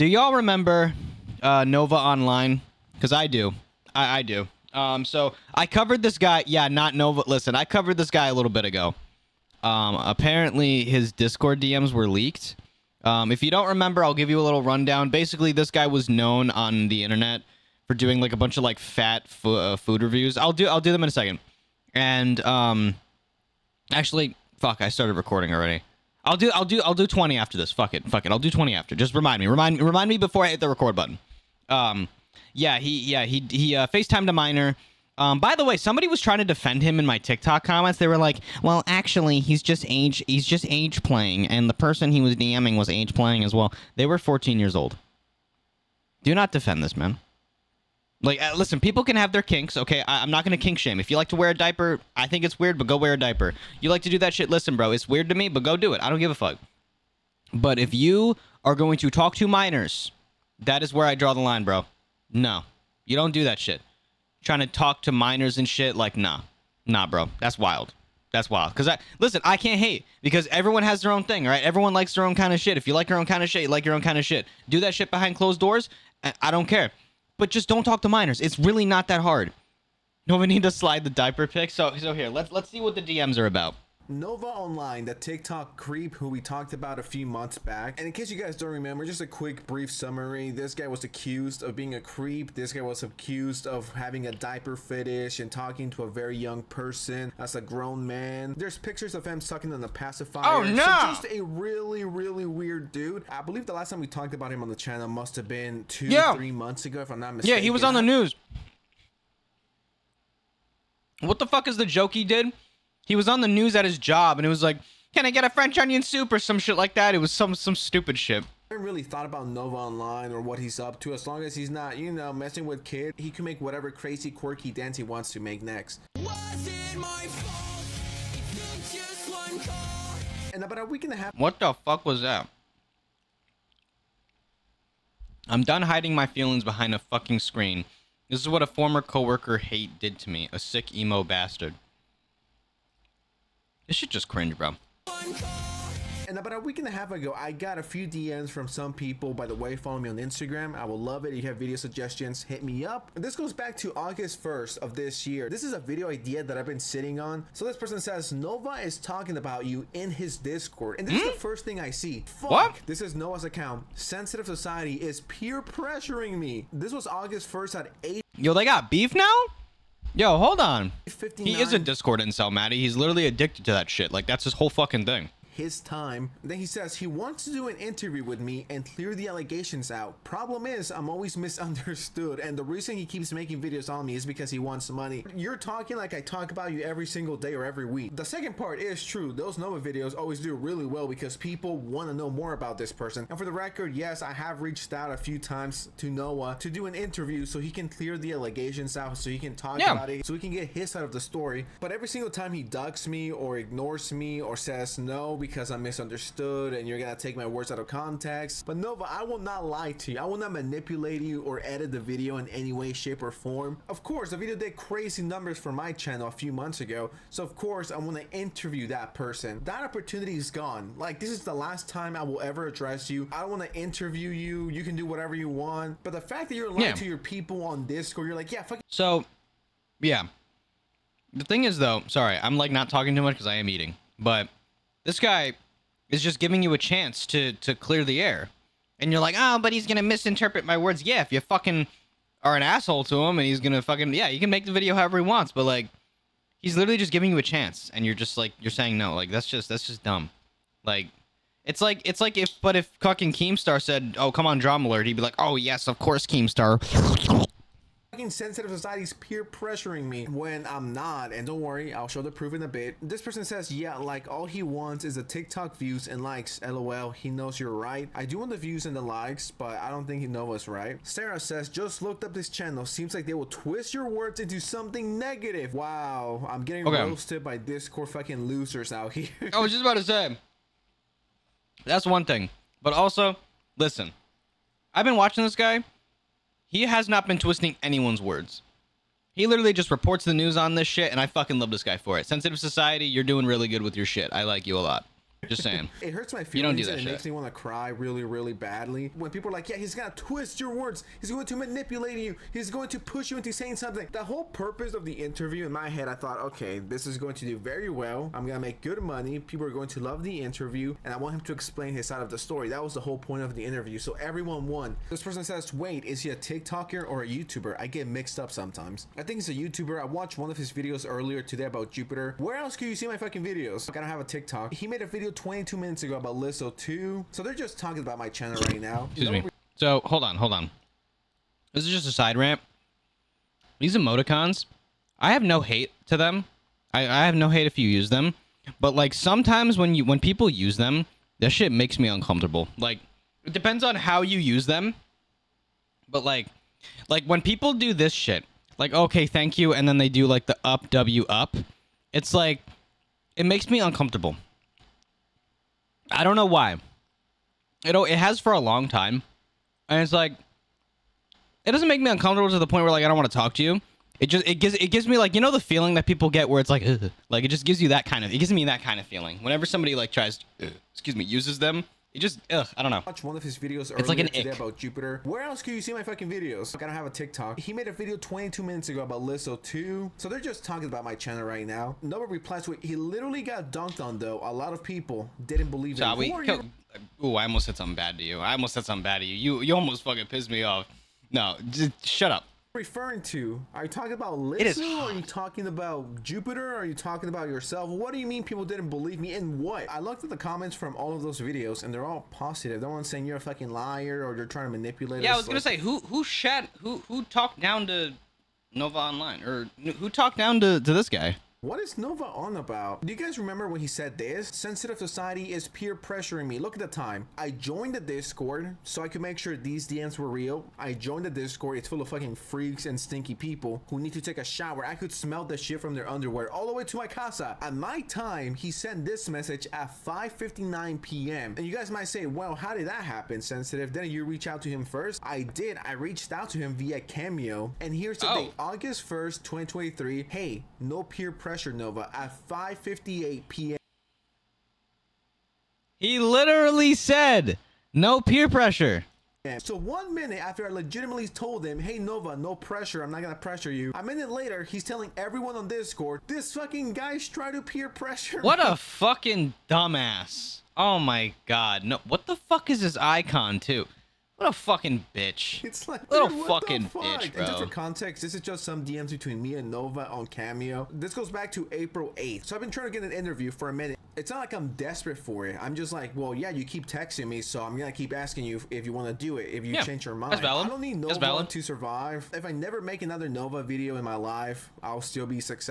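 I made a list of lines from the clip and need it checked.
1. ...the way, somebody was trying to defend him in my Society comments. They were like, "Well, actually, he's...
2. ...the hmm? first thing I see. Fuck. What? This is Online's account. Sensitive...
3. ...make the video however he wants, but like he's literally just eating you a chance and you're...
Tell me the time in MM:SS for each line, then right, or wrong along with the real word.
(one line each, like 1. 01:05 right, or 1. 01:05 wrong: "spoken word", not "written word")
1. 00:35 wrong: "TikTok", not "Society"
2. 02:41 wrong: "Nova", not "Online"
3. 04:04 wrong: "giving", not "eating".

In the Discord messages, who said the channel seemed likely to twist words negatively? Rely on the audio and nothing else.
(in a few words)
Sarah.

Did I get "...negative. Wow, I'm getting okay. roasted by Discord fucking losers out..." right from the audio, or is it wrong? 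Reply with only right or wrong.
right.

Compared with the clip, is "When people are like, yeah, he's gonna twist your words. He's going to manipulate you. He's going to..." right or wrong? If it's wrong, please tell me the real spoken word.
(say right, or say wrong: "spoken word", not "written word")
right.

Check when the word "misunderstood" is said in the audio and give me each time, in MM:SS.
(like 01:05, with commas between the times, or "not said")
03:01, 03:25.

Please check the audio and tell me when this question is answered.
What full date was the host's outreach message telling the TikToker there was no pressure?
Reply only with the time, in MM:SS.
07:18.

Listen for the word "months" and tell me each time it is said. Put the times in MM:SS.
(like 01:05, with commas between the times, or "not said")
01:27, 01:46, 03:36.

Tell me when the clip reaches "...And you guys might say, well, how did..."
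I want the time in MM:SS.
07:11.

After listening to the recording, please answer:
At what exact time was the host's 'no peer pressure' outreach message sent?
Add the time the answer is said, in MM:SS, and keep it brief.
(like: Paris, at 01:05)
5:58 p.m., at 07:22.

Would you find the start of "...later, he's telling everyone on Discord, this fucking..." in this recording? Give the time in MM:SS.
07:34.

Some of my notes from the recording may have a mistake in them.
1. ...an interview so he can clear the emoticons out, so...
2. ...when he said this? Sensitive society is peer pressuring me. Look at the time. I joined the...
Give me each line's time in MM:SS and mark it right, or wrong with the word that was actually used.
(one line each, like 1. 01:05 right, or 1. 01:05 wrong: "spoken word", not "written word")
1. 03:16 wrong: "allegations", not "emoticons"
2. 06:53 right.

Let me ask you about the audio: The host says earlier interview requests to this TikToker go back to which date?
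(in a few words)
April 8th.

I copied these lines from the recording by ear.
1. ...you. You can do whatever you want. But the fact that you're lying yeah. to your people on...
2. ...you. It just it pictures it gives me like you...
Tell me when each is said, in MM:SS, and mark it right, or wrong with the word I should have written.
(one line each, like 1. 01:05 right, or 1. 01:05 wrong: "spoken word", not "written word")
1. 03:44 right
2. 06:03 wrong: "gives", not "pictures".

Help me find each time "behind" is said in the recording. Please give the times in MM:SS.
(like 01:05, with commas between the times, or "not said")
01:15, 02:16.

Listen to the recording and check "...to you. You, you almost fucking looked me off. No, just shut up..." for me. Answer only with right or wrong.
wrong.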